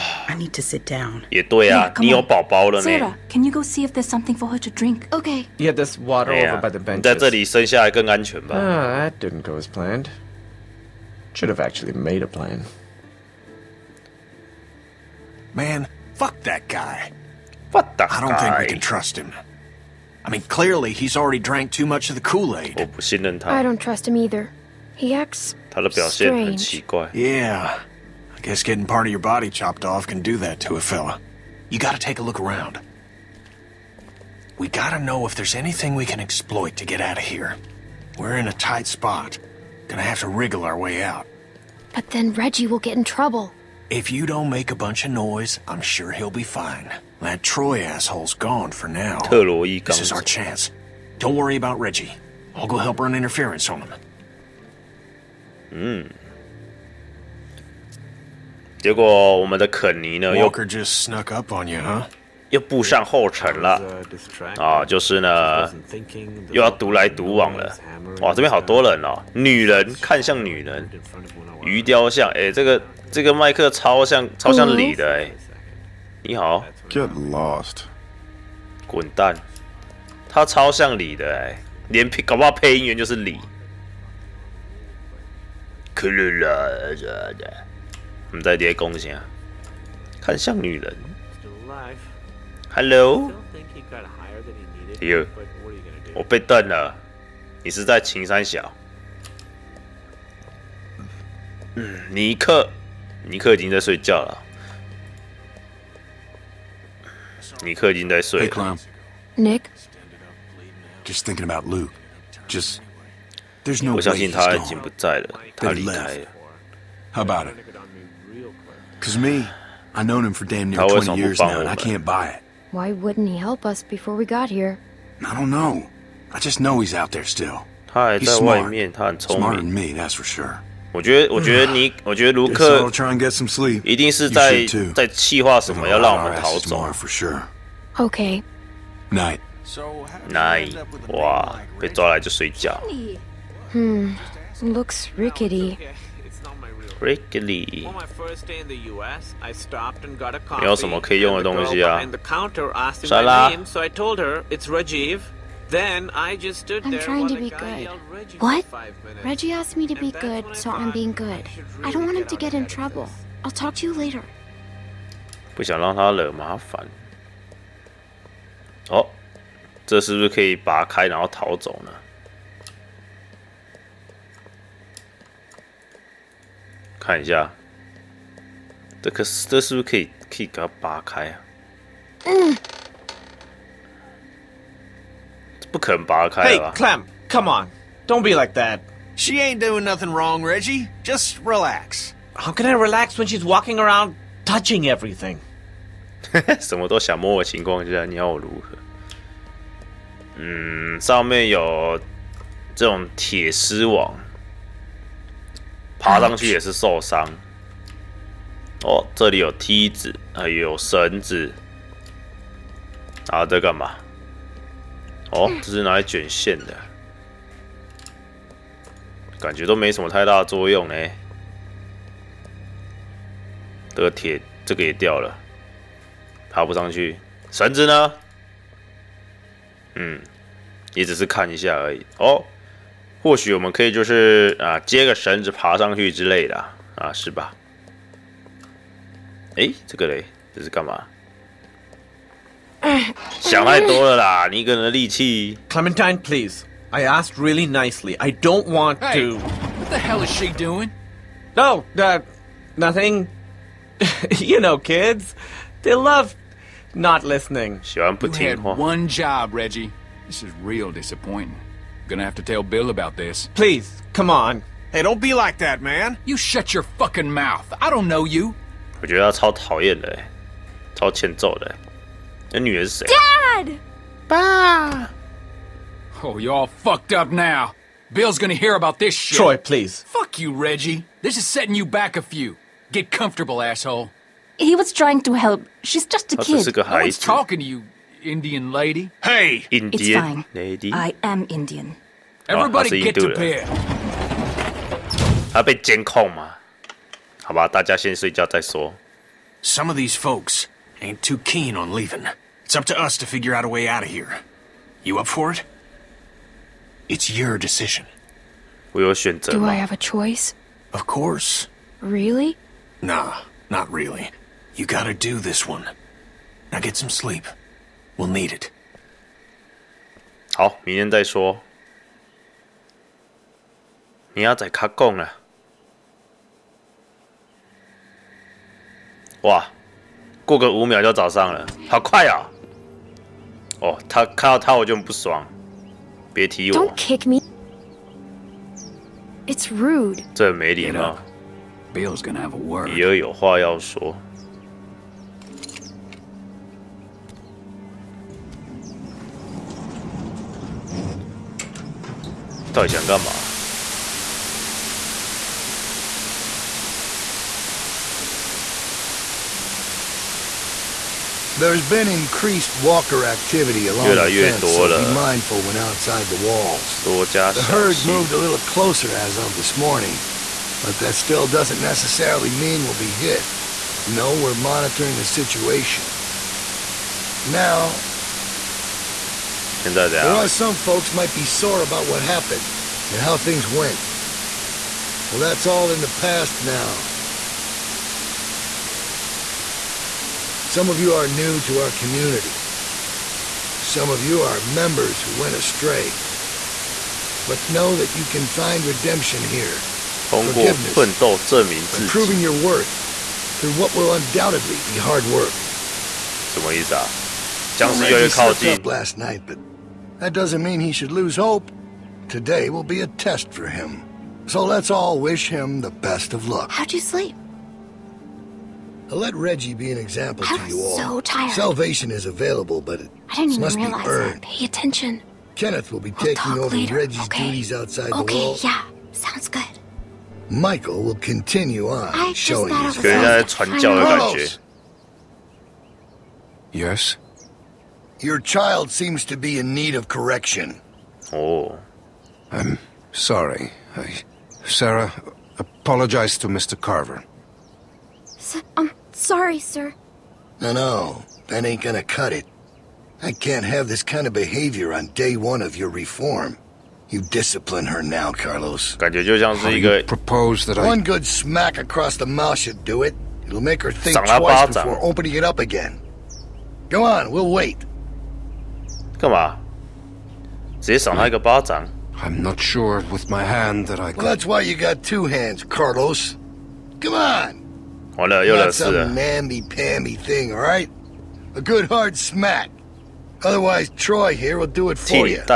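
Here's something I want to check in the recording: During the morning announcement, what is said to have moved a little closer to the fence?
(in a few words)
The herd.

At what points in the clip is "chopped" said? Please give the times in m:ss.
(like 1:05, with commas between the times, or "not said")
0:29.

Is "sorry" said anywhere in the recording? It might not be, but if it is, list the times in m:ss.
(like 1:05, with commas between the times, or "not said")
7:23, 7:29.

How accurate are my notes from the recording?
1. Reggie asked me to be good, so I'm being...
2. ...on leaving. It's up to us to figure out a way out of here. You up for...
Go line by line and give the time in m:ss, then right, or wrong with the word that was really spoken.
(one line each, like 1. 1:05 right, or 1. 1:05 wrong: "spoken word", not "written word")
1. 2:39 right
2. 5:01 right.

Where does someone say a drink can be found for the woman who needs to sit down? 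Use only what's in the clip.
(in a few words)
By the bench.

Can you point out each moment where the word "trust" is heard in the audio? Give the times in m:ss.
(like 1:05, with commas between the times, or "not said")
0:18, 0:23.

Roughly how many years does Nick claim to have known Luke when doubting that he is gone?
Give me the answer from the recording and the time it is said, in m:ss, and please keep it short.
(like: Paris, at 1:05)
20, at 2:00.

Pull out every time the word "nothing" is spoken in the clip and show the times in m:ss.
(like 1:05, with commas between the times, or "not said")
3:09, 4:12.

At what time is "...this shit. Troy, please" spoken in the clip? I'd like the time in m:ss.
4:38.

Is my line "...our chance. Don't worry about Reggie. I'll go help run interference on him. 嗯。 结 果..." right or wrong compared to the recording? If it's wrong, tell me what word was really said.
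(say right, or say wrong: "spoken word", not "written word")
right.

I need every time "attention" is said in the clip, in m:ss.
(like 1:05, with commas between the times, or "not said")
7:04.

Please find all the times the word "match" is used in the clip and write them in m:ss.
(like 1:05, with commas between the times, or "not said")
not said.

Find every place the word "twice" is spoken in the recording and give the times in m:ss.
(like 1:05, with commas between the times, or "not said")
7:44.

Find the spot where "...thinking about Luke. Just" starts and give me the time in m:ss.
1:51.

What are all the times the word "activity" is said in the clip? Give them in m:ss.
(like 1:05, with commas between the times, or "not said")
6:03.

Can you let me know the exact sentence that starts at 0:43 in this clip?
If you don't make a bunch of noise, I'm sure he'll be fine.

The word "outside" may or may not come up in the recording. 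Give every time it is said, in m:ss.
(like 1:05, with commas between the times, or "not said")
6:05, 7:07.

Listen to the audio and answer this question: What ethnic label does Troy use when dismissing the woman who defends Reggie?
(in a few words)
Indian lady.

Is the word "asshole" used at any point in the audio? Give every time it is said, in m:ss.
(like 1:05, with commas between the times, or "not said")
0:47, 4:43.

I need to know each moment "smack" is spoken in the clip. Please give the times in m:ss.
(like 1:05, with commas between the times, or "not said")
7:41, 8:02.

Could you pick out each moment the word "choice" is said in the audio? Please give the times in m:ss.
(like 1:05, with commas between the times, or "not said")
5:09.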